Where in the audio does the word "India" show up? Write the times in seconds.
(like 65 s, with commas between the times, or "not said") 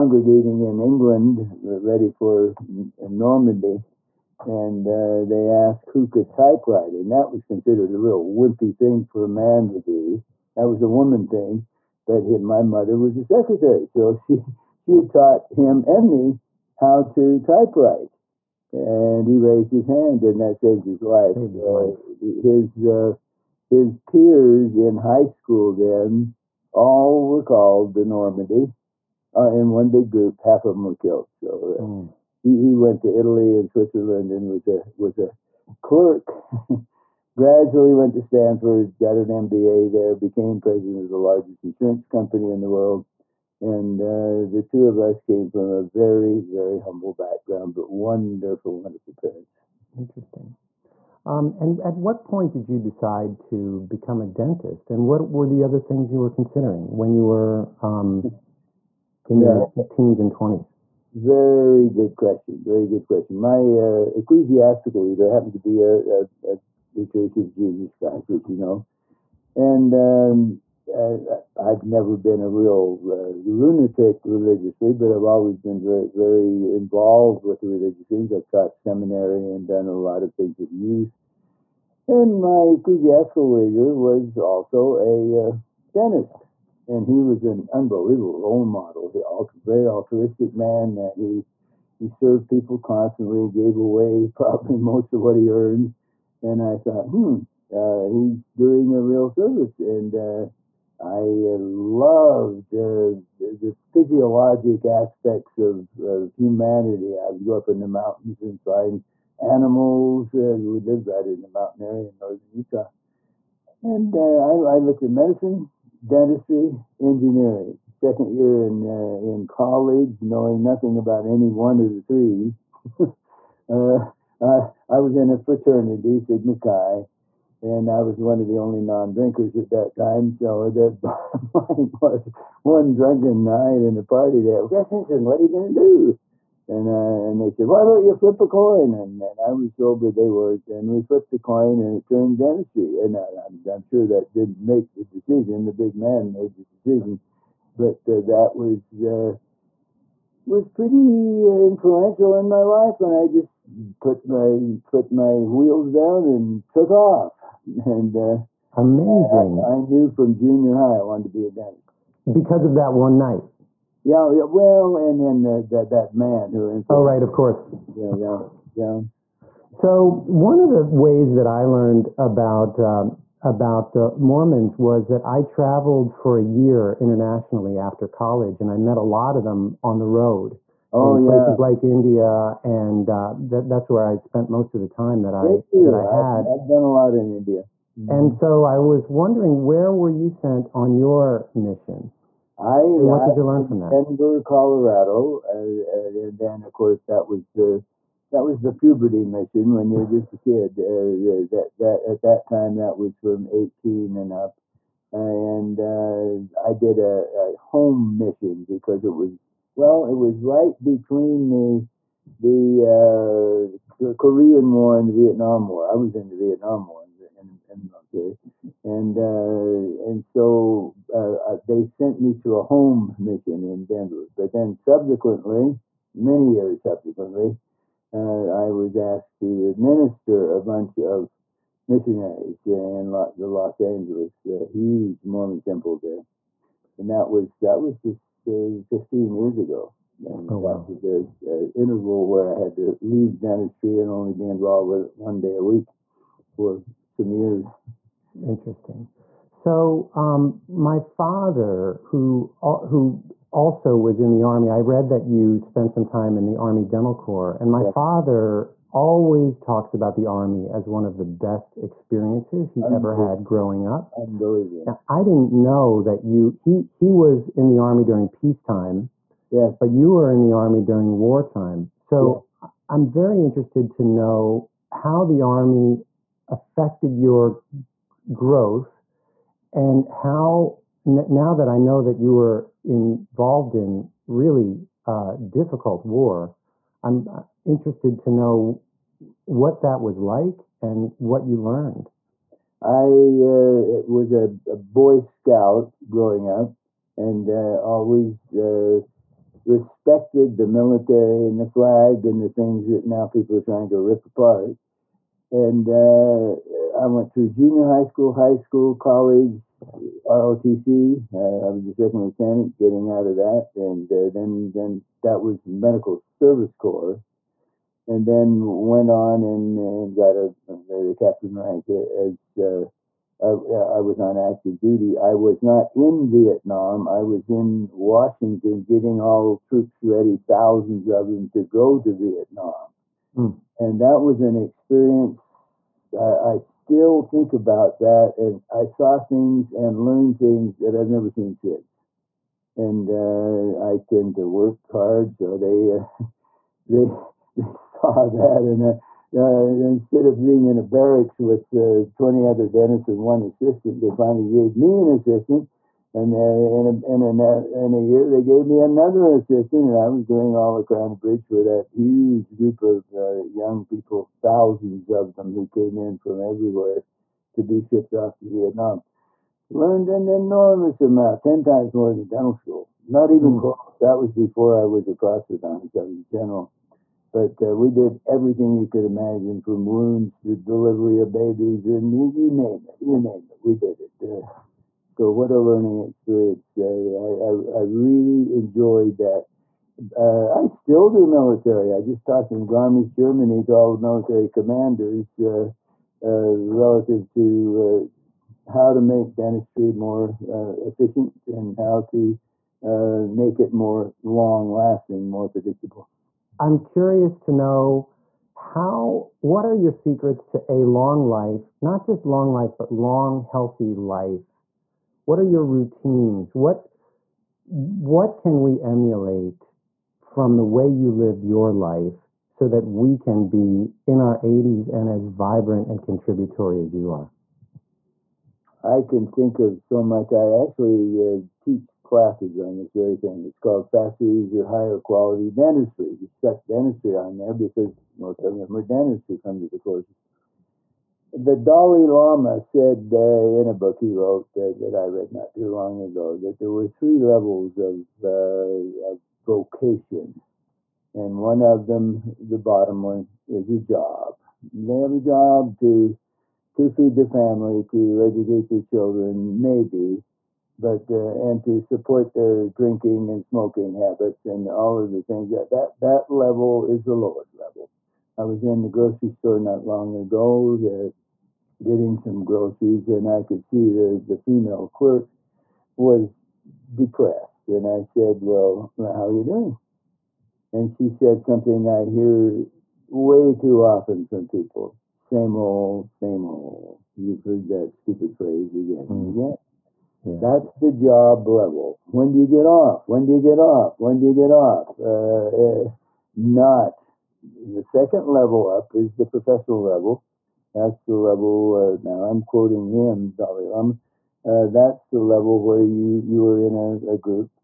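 181 s, 187 s.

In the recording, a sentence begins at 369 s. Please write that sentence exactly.
Learned an enormous amount, 10 times more than dental school.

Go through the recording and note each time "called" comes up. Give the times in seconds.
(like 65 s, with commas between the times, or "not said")
27 s, 433 s.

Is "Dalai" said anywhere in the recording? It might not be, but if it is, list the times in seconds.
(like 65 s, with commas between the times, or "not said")
441 s, 503 s.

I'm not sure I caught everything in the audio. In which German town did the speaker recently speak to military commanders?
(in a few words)
Garmisch.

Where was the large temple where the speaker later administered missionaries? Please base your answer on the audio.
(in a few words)
Los Angeles.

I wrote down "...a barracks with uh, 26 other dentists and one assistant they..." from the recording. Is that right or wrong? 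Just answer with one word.
wrong.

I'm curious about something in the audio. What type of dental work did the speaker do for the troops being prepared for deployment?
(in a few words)
Crown Bridge.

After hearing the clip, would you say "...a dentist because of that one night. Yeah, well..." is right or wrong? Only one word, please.
right.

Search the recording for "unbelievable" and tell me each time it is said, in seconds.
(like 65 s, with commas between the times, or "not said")
87 s.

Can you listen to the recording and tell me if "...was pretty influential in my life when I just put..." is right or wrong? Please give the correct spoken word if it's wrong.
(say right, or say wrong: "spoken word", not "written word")
right.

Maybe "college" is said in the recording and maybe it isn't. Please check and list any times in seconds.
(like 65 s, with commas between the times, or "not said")
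119 s, 178 s, 308 s.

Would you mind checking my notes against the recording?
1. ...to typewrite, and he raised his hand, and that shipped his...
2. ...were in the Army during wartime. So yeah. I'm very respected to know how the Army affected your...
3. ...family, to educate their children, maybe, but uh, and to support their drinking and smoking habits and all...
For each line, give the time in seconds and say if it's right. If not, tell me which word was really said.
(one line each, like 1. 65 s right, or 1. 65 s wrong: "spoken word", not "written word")
1. 17 s wrong: "saved", not "shipped"
2. 270 s wrong: "interested", not "respected"
3. 457 s right.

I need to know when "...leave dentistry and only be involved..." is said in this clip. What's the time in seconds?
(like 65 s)
243 s.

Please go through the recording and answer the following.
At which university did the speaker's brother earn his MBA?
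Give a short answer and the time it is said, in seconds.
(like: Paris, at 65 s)
Stanford, at 38 s.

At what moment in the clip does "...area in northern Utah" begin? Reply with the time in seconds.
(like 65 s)
111 s.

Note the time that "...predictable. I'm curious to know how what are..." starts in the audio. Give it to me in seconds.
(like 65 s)
405 s.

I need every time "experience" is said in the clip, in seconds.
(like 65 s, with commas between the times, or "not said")
261 s, 334 s, 385 s.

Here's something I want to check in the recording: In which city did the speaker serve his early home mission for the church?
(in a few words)
Denver, Colorado.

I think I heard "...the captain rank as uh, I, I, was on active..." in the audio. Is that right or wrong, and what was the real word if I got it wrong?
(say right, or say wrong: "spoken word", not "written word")
right.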